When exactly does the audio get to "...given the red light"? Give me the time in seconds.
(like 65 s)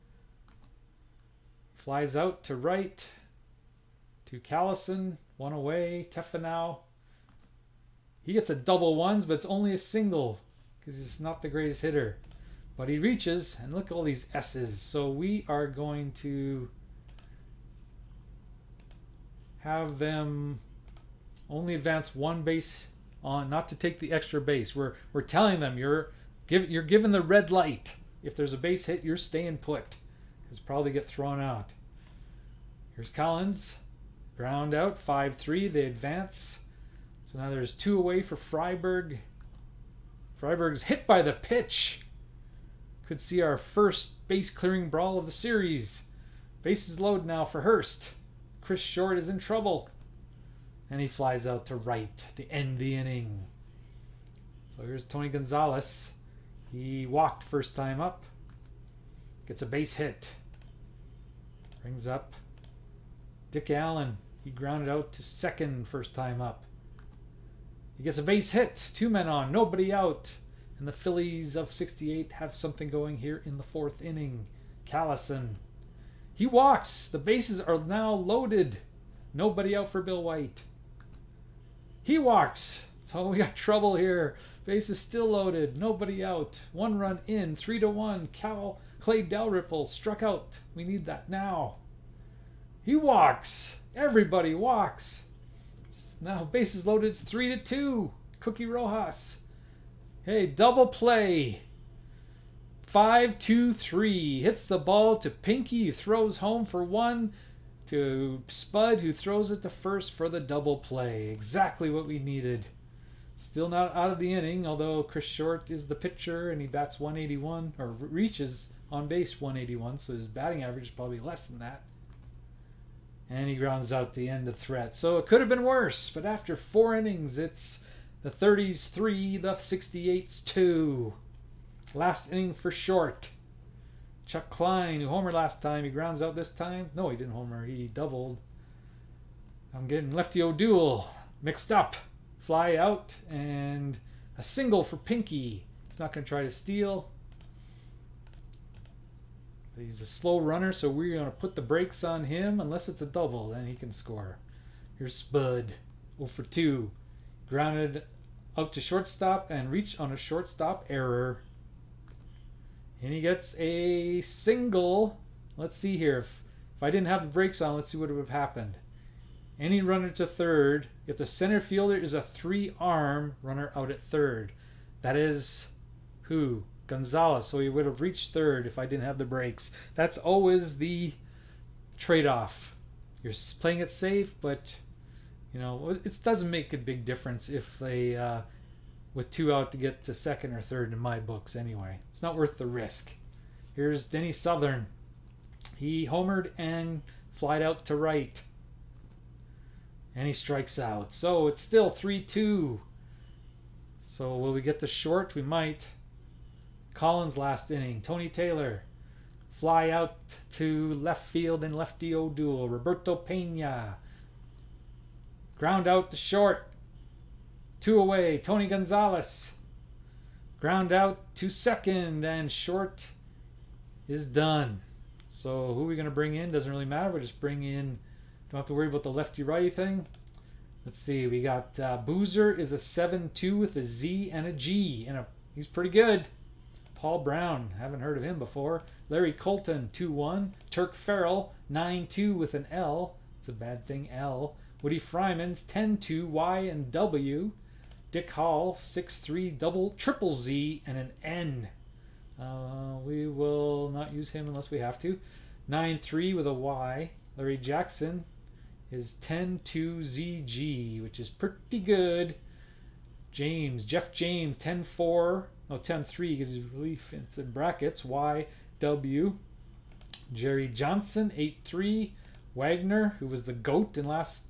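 26 s.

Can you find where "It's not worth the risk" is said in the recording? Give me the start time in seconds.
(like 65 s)
192 s.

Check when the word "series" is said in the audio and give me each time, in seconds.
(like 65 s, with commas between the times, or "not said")
45 s.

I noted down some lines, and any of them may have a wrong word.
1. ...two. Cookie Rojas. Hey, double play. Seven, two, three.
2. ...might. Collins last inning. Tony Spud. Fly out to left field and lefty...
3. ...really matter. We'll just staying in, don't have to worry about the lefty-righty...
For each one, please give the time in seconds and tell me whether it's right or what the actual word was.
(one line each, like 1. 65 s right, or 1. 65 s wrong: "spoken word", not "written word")
1. 97 s wrong: "Five", not "Seven"
2. 205 s wrong: "Taylor", not "Spud"
3. 226 s wrong: "bring", not "staying".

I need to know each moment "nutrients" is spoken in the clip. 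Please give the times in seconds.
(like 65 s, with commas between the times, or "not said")
not said.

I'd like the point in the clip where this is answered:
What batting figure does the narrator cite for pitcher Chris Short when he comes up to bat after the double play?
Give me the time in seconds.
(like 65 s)
116 s.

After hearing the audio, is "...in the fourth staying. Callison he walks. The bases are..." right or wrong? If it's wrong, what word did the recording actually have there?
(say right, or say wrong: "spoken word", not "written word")
wrong: "inning", not "staying".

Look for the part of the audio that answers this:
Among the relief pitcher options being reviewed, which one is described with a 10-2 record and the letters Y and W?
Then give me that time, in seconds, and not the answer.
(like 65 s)
244 s.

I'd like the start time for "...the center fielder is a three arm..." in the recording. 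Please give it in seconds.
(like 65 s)
171 s.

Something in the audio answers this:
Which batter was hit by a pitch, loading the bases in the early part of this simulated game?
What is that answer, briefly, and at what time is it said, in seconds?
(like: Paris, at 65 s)
Friberg, at 40 s.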